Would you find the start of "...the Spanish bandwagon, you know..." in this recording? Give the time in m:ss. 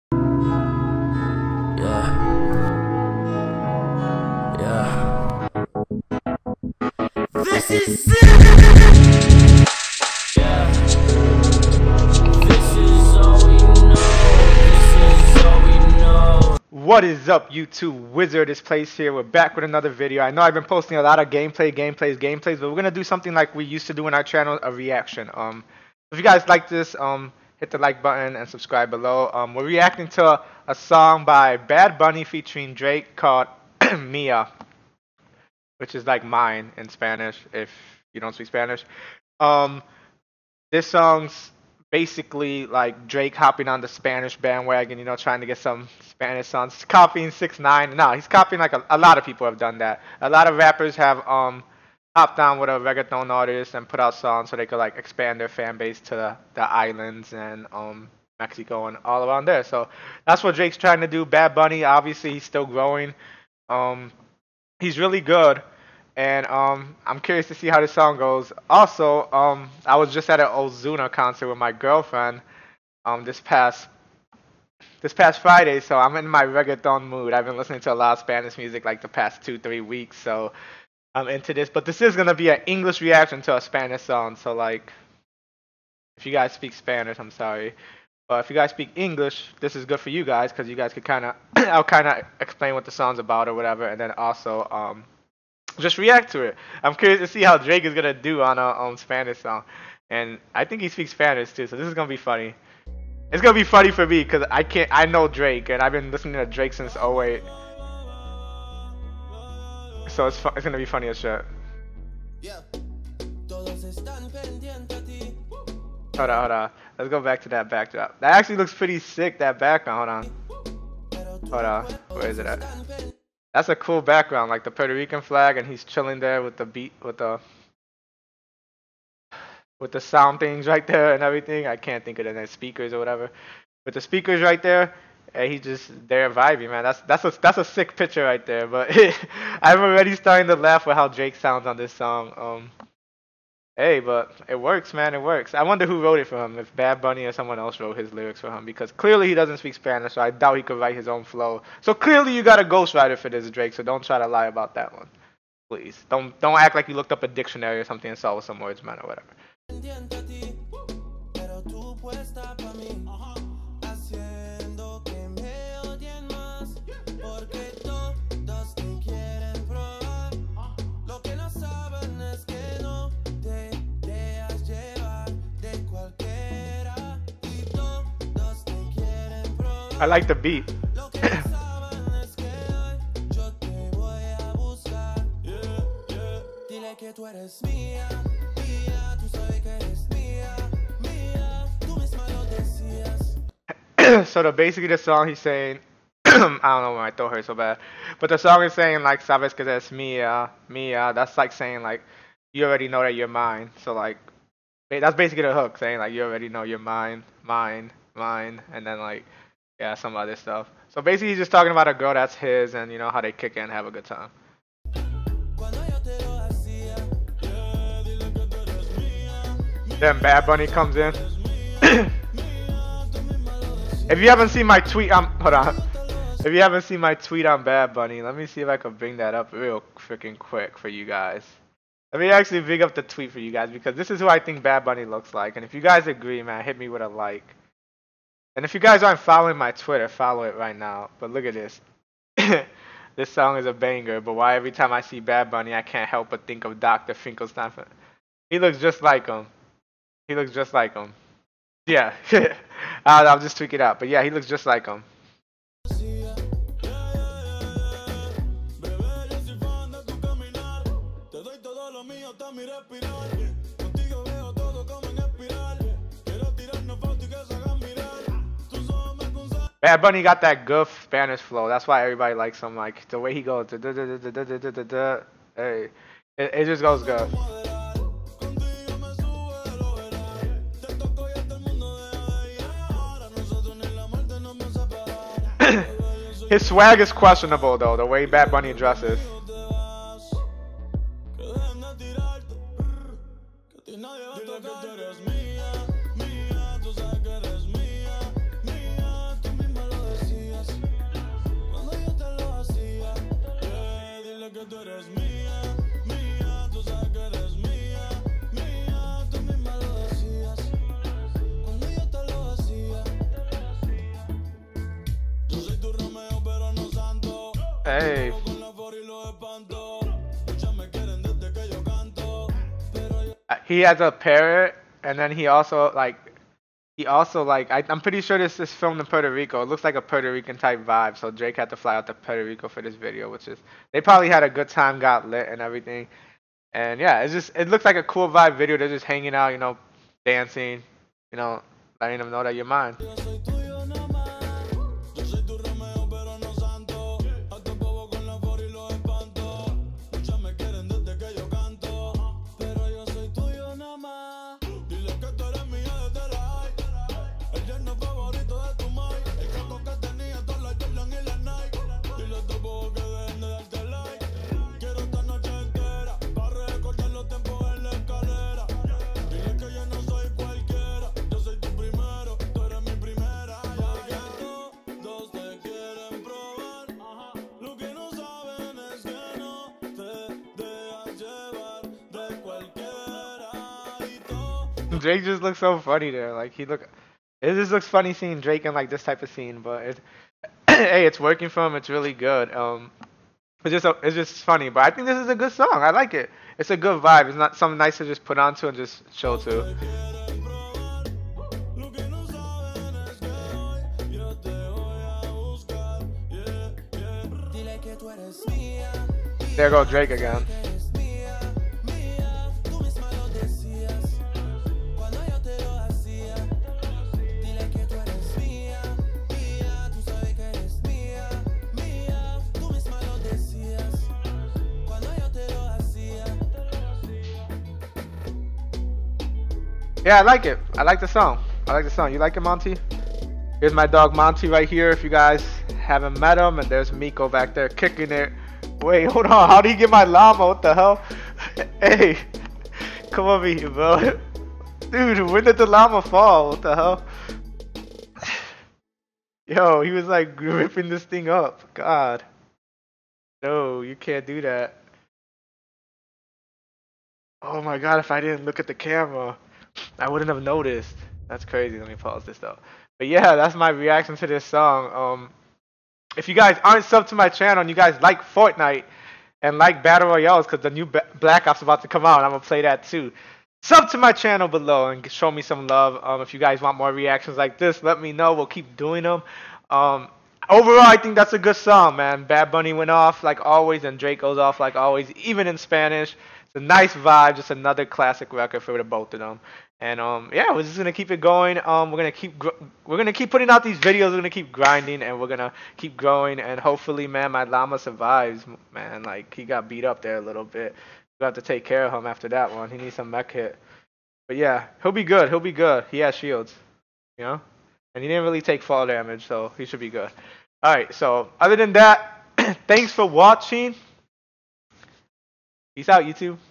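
0:43.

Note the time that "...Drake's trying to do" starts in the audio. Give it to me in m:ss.
1:00.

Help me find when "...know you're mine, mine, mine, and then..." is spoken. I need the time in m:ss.
3:26.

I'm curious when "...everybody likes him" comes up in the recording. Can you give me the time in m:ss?
4:32.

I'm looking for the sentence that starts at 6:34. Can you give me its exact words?
But I think this is a good song.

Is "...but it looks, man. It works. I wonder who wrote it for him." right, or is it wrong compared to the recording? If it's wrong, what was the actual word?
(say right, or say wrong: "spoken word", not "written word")
wrong: "works", not "looks".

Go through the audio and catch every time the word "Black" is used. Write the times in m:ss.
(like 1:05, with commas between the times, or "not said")
7:51.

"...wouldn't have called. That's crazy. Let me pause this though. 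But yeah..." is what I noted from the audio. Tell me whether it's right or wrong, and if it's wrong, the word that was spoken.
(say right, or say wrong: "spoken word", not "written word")
wrong: "noticed", not "called".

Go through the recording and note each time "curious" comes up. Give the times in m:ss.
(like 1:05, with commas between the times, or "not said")
1:07, 1:36.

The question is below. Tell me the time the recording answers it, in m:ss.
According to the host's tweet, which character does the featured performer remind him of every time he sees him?
4:06.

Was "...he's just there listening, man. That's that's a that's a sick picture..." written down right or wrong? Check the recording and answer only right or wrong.
wrong.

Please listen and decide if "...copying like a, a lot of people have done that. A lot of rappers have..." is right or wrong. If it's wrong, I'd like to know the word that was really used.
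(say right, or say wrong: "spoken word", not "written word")
right.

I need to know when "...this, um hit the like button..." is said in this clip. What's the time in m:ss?
0:26.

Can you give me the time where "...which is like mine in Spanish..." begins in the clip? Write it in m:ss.
0:35.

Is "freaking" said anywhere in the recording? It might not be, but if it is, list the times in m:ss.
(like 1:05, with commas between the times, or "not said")
3:49.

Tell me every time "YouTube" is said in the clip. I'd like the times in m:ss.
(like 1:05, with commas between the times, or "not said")
0:17, 8:36.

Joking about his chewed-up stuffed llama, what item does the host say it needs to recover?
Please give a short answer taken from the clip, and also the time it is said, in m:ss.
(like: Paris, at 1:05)
med kit, at 8:23.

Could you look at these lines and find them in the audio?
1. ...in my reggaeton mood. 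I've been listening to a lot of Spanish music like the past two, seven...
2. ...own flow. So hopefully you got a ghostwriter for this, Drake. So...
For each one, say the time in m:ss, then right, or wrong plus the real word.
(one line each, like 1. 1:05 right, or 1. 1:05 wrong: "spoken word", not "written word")
1. 1:16 wrong: "three", not "seven"
2. 2:31 wrong: "clearly", not "hopefully".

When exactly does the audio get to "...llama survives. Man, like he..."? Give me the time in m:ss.
8:17.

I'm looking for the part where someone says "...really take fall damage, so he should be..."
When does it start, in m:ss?
8:28.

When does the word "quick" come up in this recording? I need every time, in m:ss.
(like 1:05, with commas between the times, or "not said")
3:50.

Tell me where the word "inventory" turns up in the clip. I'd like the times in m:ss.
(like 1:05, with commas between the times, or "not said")
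not said.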